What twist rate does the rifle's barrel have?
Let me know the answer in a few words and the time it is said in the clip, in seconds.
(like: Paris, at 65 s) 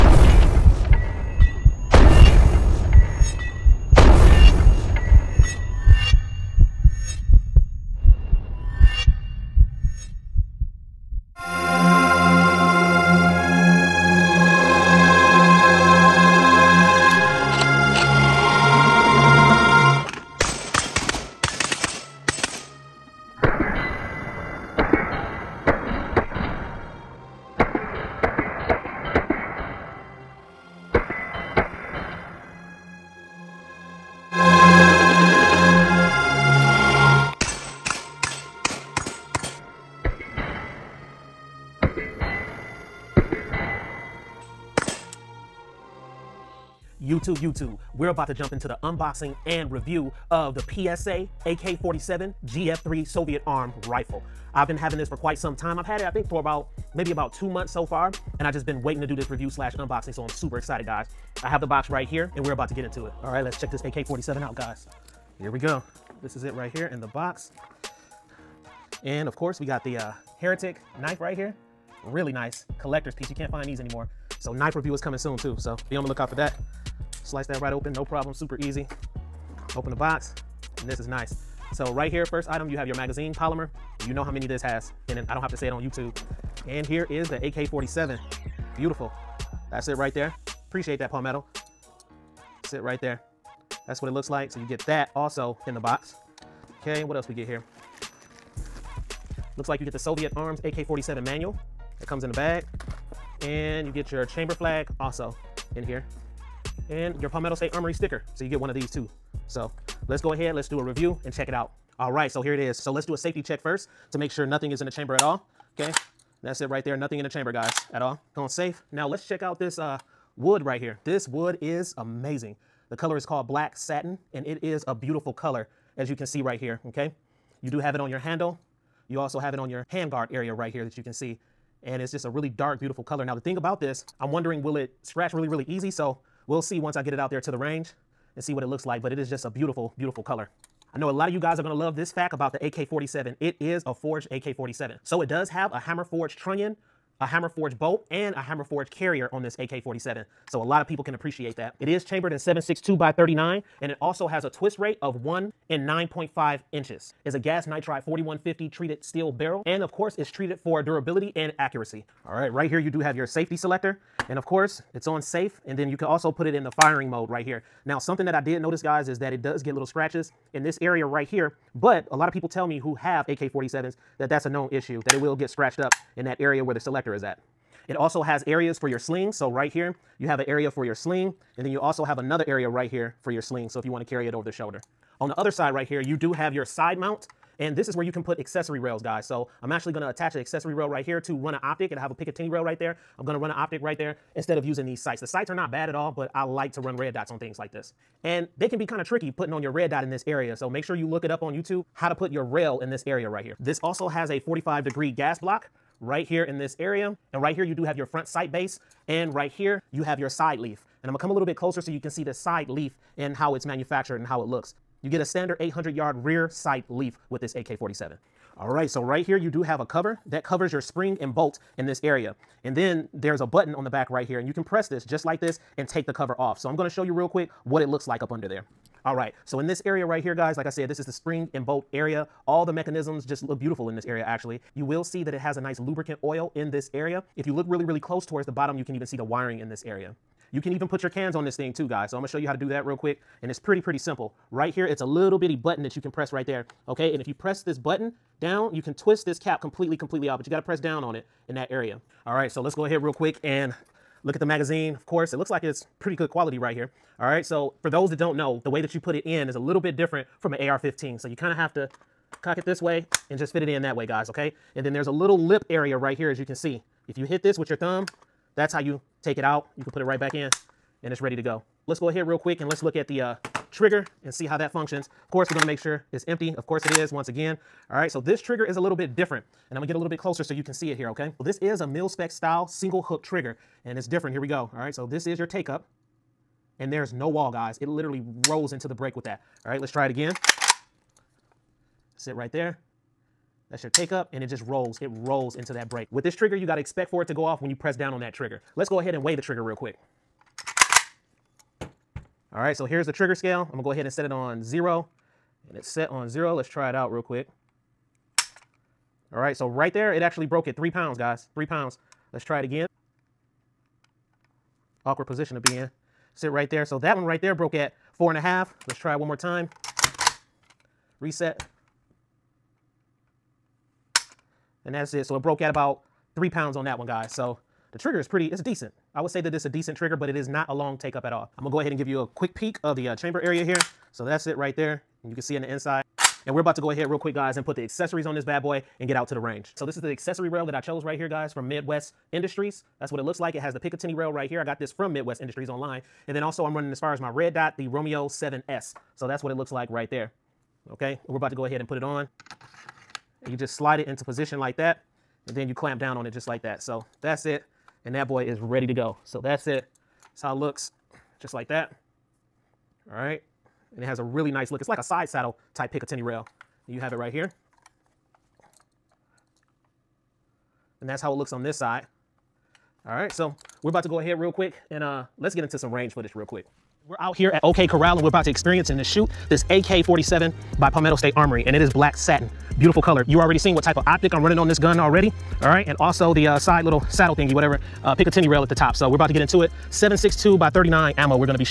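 1 in 9.5 inches, at 155 s.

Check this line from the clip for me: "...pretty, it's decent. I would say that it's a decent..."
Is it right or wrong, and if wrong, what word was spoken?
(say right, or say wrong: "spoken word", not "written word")
right.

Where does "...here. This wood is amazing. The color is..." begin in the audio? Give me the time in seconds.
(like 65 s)
120 s.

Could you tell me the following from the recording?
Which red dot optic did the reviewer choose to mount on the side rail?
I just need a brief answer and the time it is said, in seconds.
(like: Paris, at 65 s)
Romeo 7S, at 347 s.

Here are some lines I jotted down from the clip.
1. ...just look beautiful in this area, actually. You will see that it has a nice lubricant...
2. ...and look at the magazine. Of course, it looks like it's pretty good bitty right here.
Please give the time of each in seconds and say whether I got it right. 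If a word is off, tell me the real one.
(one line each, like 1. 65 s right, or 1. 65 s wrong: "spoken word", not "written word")
1. 233 s right
2. 253 s wrong: "quality", not "bitty".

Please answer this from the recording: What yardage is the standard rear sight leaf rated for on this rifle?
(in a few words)
800 yards.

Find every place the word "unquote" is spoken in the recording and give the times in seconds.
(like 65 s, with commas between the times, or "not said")
not said.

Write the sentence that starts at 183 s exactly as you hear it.
So if you want to carry it over the shoulder.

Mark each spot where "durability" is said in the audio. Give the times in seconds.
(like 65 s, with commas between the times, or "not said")
160 s.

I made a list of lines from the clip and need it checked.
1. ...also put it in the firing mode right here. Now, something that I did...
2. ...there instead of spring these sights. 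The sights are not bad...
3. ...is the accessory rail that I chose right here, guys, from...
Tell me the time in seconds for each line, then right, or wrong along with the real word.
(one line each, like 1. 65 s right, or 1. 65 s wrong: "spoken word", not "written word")
1. 166 s right
2. 193 s wrong: "using", not "spring"
3. 339 s right.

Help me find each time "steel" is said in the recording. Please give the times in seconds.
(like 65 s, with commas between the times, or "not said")
159 s.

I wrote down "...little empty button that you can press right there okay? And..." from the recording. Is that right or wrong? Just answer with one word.
wrong.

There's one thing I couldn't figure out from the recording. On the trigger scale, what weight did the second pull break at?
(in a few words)
4.5 pounds.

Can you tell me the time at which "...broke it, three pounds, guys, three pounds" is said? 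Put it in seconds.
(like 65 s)
310 s.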